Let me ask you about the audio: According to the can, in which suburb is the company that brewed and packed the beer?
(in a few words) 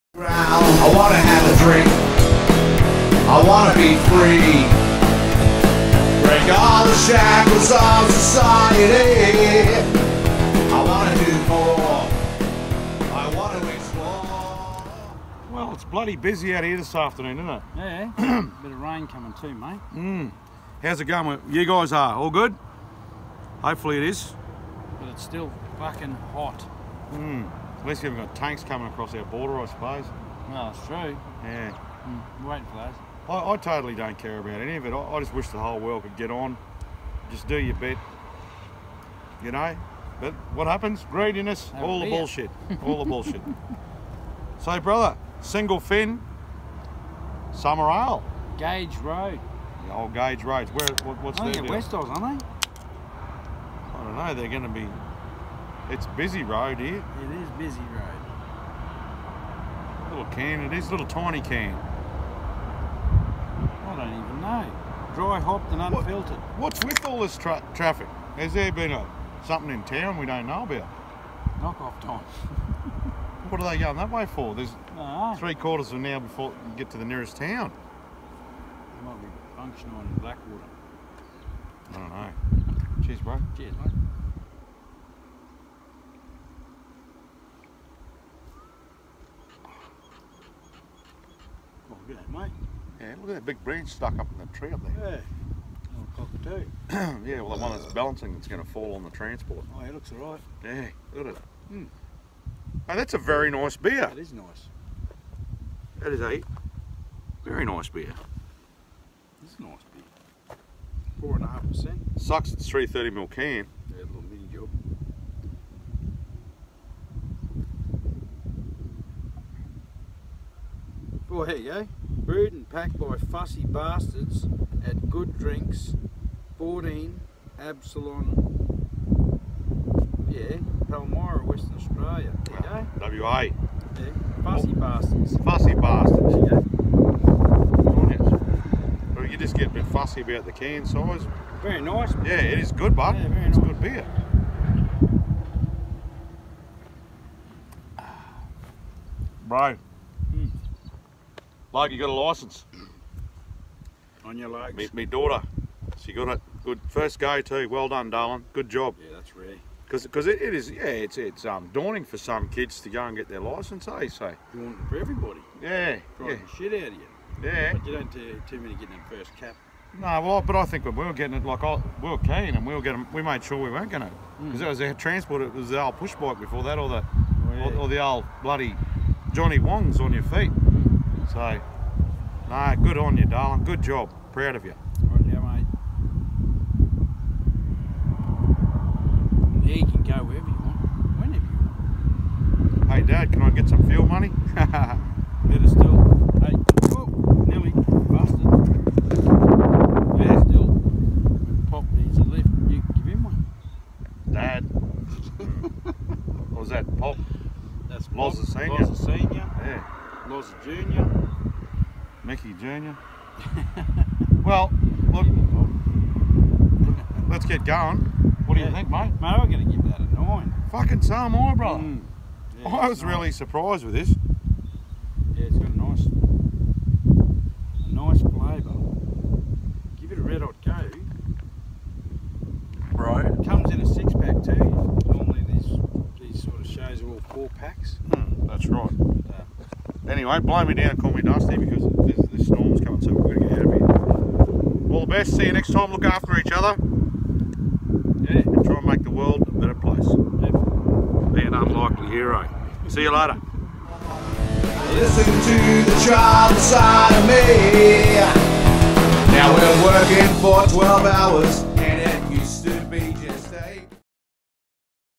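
Palmyra.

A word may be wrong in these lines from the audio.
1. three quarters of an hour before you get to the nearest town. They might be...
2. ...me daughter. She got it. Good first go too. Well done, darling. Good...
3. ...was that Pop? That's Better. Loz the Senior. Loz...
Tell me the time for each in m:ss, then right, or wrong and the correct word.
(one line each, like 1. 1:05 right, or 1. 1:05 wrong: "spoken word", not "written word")
1. 1:15 right
2. 2:34 right
3. 3:26 wrong: "Pop", not "Better".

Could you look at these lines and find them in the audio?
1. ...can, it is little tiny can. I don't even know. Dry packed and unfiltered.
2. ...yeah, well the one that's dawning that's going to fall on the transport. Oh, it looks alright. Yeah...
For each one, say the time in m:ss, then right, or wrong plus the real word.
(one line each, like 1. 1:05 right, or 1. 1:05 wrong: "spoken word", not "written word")
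1. 1:00 wrong: "hopped", not "packed"
2. 1:37 wrong: "balancing", not "dawning".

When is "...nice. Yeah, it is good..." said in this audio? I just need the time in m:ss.
2:21.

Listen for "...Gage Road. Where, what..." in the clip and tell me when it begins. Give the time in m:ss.
0:50.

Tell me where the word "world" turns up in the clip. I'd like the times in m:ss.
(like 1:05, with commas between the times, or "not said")
0:35, 4:09.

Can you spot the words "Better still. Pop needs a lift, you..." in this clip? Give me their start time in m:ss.
3:20.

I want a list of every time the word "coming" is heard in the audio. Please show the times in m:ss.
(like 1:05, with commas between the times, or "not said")
0:19, 0:28, 4:02.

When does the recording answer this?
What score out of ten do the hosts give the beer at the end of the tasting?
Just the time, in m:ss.
3:40.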